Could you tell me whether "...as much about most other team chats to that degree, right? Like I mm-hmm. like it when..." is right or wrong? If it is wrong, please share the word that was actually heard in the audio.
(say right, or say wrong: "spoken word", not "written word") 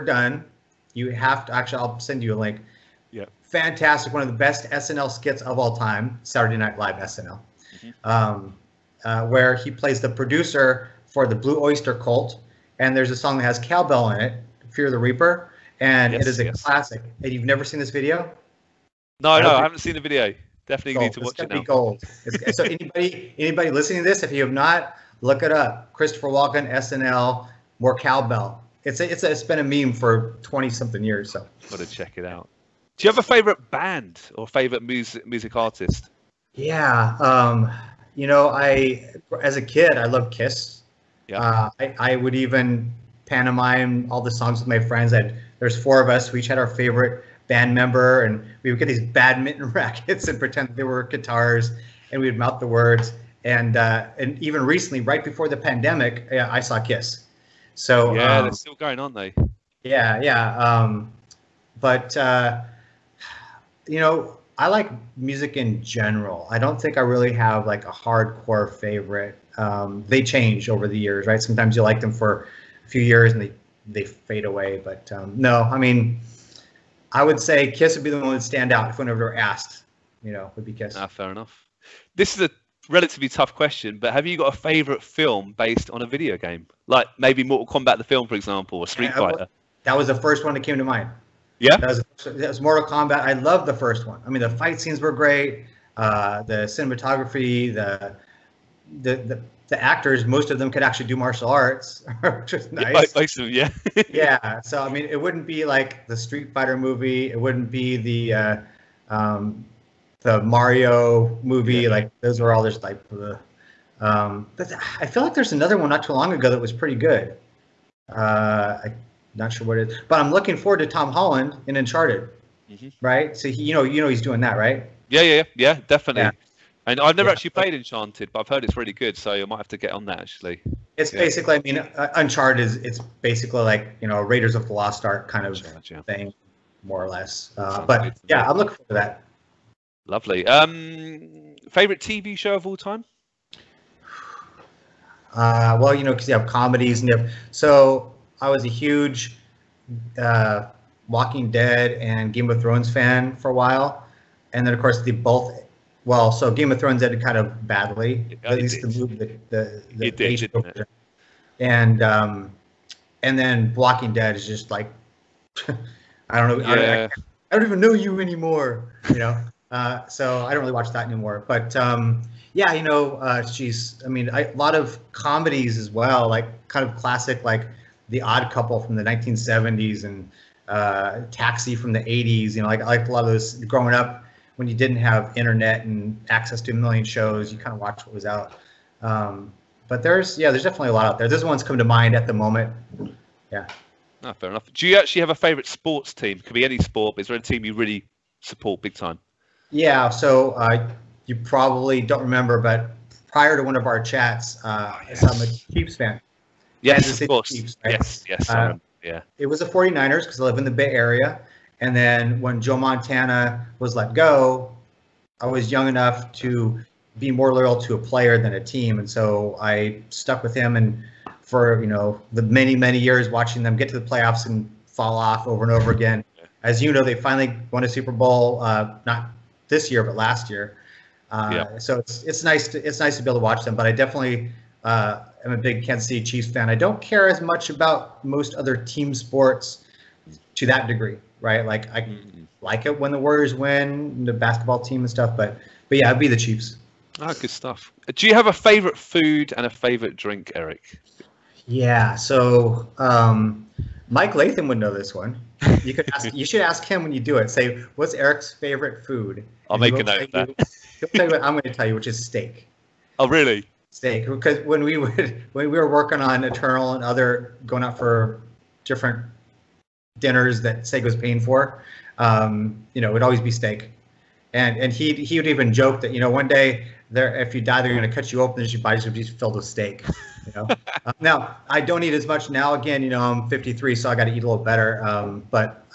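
wrong: "sports", not "chats".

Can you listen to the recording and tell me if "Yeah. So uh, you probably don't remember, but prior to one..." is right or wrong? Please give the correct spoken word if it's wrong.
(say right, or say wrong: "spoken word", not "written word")
right.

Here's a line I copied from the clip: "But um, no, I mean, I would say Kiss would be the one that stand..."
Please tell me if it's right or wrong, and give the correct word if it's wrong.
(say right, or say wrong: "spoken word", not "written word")
right.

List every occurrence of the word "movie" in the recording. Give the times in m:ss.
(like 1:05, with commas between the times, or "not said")
1:46, 1:51, 2:38.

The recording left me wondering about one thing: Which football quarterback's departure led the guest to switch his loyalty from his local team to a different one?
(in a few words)
Joe Montana.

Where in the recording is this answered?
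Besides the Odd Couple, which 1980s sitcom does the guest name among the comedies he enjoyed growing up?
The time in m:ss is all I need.
3:01.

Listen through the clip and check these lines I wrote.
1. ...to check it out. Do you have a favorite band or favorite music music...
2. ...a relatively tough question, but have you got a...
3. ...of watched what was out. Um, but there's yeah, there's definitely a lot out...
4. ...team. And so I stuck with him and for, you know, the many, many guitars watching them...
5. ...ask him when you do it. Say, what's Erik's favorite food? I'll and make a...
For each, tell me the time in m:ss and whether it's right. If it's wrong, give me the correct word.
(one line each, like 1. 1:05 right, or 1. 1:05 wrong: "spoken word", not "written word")
1. 0:31 right
2. 1:22 right
3. 3:07 right
4. 3:38 wrong: "years", not "guitars"
5. 4:16 right.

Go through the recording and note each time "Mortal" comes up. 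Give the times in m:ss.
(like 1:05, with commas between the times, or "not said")
1:27, 1:32.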